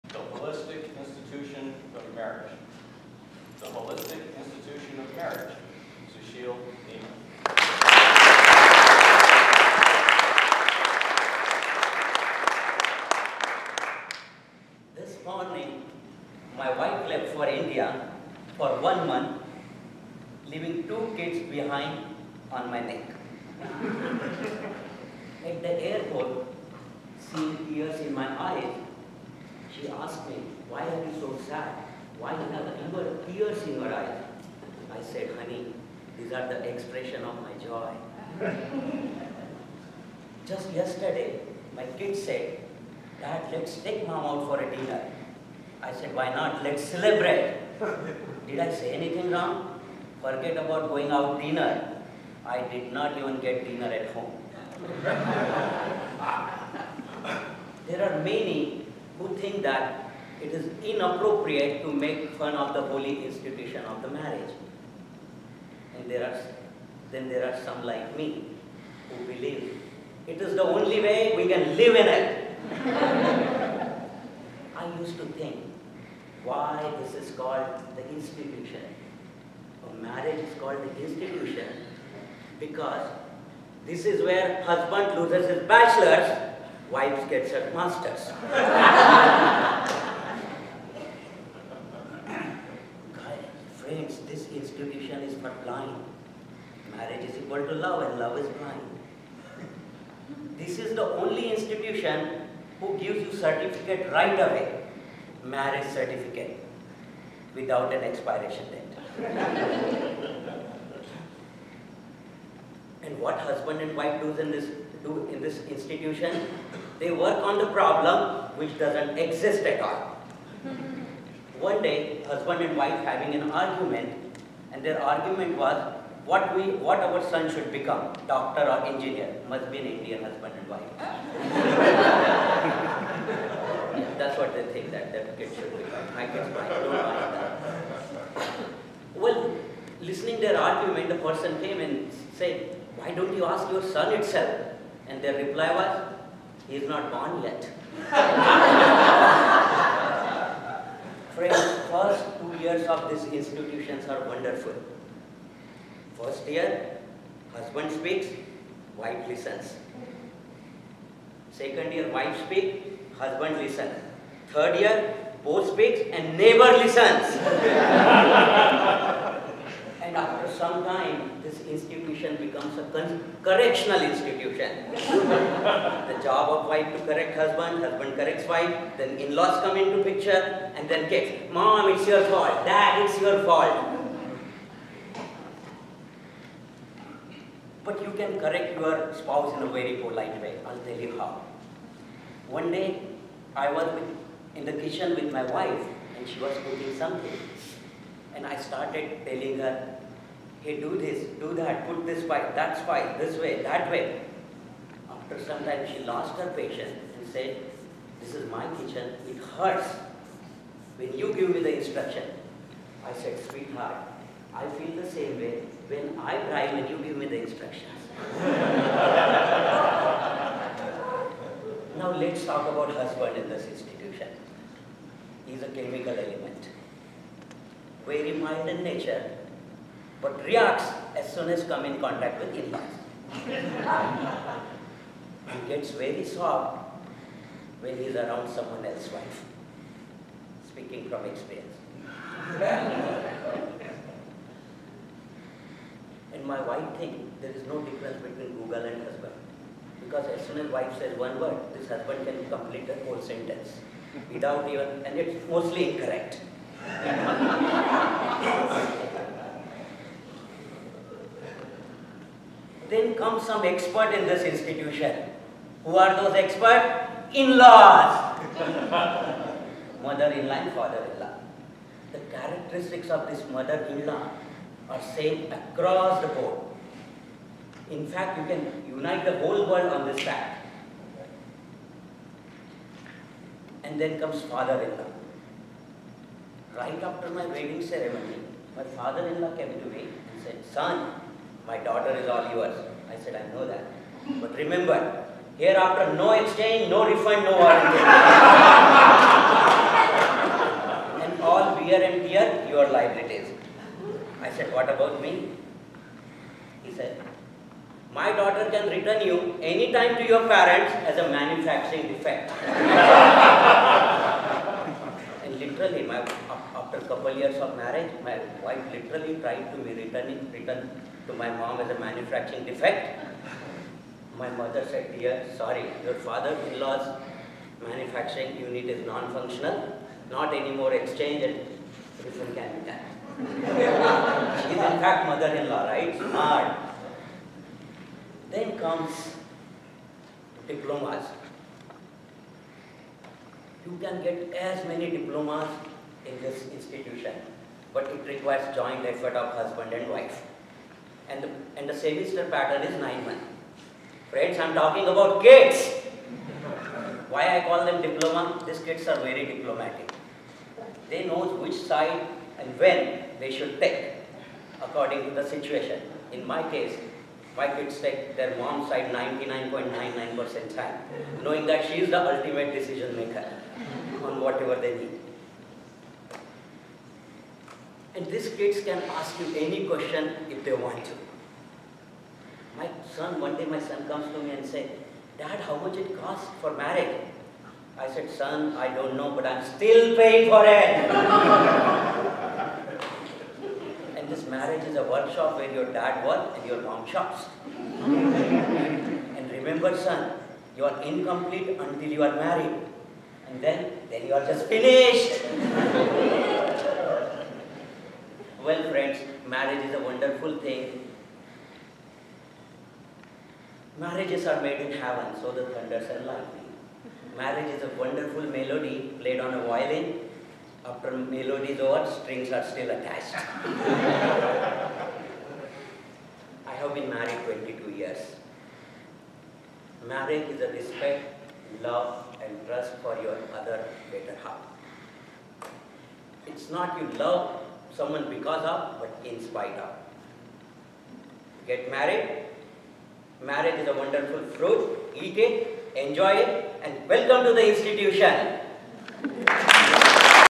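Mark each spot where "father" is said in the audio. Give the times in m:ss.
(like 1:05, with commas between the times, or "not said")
4:30, 4:44, 4:48, 5:26.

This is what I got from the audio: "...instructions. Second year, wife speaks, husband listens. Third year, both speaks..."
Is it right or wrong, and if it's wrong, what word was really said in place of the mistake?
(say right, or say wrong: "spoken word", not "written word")
wrong: "listens", not "instructions".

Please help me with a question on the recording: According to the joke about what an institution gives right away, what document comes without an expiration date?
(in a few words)
Marriage certificate.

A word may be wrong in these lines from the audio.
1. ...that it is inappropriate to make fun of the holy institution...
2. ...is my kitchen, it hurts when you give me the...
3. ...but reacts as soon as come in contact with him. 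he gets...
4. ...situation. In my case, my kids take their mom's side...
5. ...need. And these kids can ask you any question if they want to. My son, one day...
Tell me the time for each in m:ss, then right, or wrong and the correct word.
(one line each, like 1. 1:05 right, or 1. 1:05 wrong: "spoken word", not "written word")
1. 0:59 right
2. 3:28 right
3. 3:50 right
4. 6:05 right
5. 6:14 right.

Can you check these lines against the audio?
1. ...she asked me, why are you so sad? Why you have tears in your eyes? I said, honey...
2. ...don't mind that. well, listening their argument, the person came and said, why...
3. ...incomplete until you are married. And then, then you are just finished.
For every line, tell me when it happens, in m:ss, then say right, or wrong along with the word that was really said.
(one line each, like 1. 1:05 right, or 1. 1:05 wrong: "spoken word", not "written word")
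1. 0:29 right
2. 2:16 right
3. 6:41 right.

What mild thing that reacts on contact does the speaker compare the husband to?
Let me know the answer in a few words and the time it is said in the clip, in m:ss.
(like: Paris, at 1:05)
Chemical element, at 3:45.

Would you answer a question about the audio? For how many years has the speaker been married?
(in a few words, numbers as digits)
22.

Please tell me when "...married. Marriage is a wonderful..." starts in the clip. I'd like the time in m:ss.
7:21.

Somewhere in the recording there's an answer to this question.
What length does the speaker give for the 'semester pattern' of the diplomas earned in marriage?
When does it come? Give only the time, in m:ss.
5:53.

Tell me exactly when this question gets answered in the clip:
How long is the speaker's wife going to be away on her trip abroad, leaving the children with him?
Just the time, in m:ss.
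0:18.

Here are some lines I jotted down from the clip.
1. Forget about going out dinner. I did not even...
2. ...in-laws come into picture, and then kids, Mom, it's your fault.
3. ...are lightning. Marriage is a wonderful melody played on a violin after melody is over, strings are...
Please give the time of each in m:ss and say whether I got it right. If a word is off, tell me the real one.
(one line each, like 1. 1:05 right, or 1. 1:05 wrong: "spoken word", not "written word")
1. 0:50 right
2. 2:59 right
3. 6:56 right.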